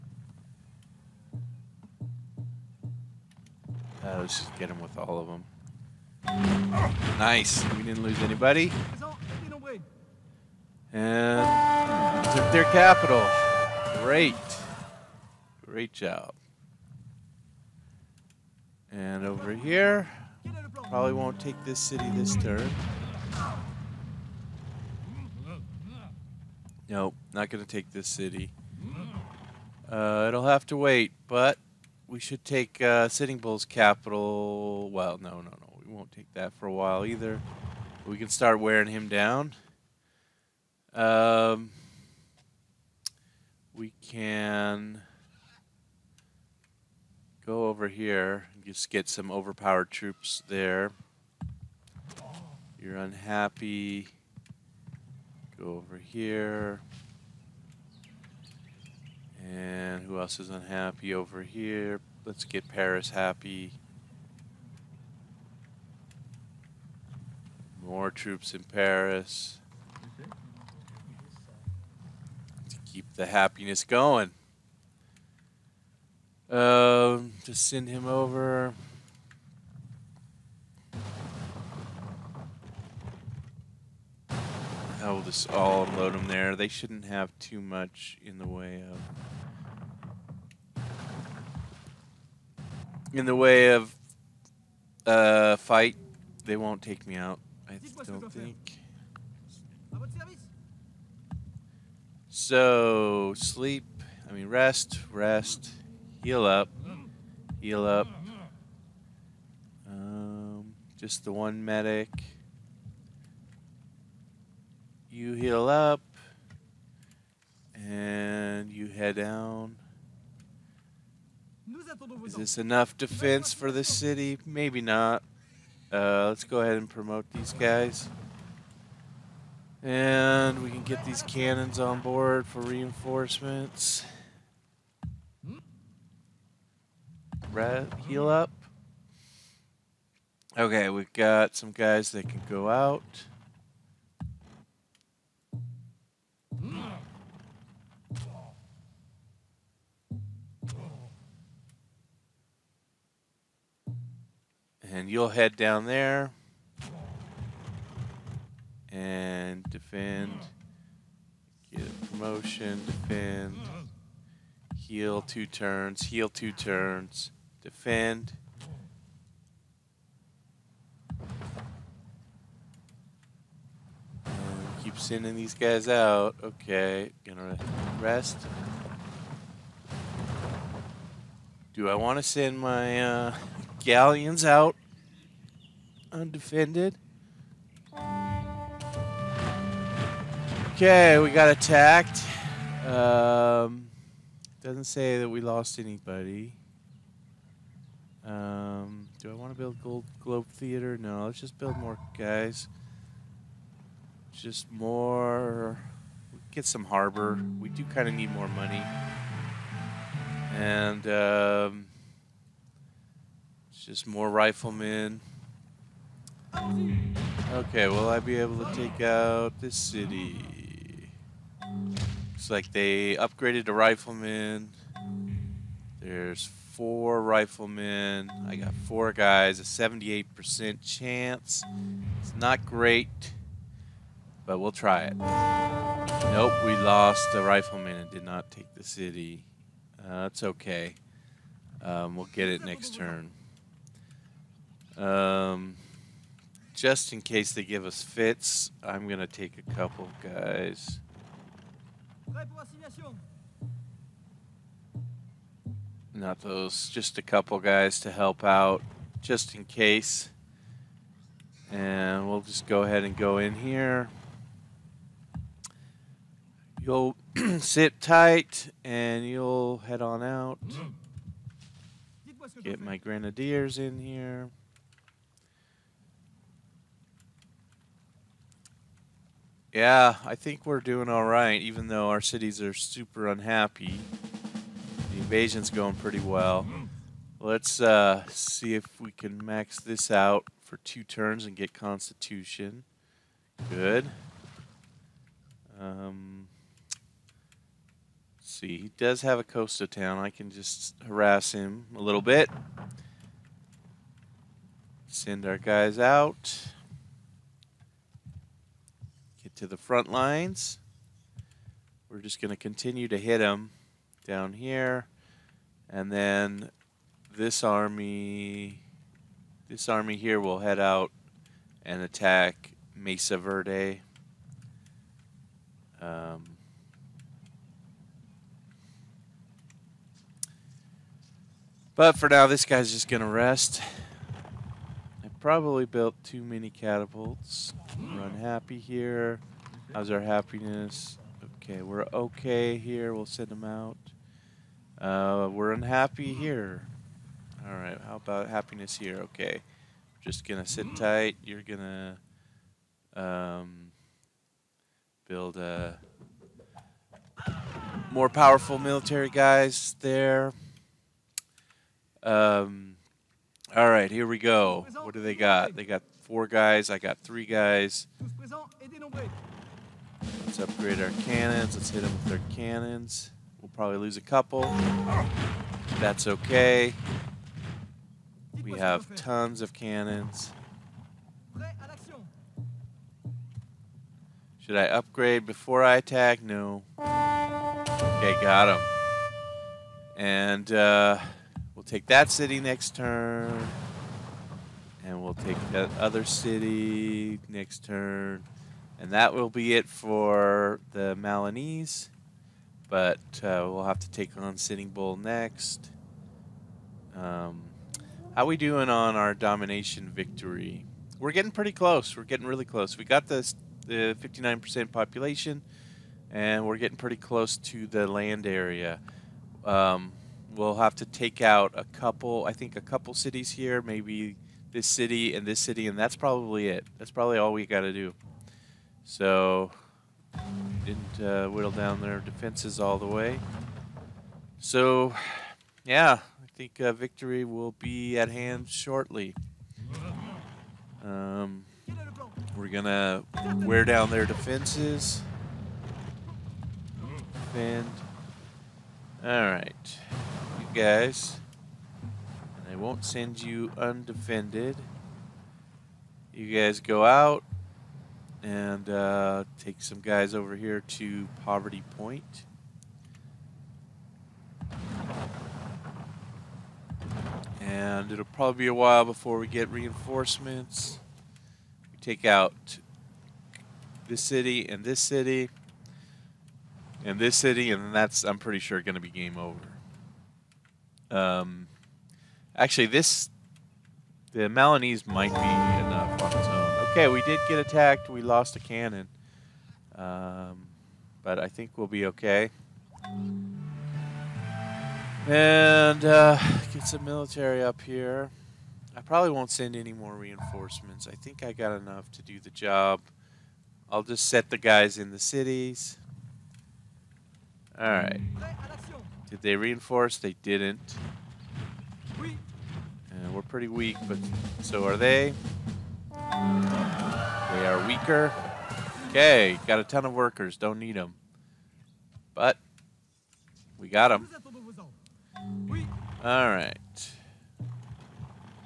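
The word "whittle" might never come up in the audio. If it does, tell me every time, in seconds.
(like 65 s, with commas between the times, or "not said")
431 s.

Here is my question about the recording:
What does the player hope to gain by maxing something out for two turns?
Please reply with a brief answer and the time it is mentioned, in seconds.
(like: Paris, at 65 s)
Constitution, at 291 s.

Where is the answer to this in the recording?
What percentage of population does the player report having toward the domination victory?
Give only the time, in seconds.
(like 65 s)
414 s.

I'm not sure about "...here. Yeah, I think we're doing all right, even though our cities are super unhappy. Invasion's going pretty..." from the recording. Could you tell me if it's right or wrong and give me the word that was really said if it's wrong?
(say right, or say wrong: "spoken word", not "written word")
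right.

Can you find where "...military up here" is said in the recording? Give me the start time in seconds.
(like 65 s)
497 s.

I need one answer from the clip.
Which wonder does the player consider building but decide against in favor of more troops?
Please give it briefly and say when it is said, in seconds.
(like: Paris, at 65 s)
Globe Theater, at 200 s.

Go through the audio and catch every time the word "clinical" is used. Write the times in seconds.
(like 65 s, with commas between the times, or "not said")
not said.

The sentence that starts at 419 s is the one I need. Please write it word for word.
Um, we'll have to take out a couple.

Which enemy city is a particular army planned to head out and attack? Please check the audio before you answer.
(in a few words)
Mesa Verde.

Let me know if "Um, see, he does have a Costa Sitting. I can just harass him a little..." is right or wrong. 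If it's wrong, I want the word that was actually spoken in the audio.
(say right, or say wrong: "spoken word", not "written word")
wrong: "Town", not "Sitting".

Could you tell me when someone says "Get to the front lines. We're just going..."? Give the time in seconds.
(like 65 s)
309 s.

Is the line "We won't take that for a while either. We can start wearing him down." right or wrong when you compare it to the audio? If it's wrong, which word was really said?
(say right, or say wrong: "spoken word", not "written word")
right.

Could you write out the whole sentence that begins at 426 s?
That's probably all we got to do.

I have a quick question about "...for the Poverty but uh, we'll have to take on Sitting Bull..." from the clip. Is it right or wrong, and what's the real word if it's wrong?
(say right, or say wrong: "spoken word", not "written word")
wrong: "Malinese", not "Poverty".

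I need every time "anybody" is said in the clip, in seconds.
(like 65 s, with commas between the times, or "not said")
8 s, 195 s.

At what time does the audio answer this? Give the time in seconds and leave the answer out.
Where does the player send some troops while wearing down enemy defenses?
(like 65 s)
461 s.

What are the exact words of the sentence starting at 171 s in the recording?
And um, keep sending these guys out.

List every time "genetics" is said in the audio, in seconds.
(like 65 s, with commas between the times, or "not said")
not said.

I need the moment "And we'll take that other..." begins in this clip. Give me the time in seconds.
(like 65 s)
395 s.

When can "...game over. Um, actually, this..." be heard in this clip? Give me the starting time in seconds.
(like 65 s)
479 s.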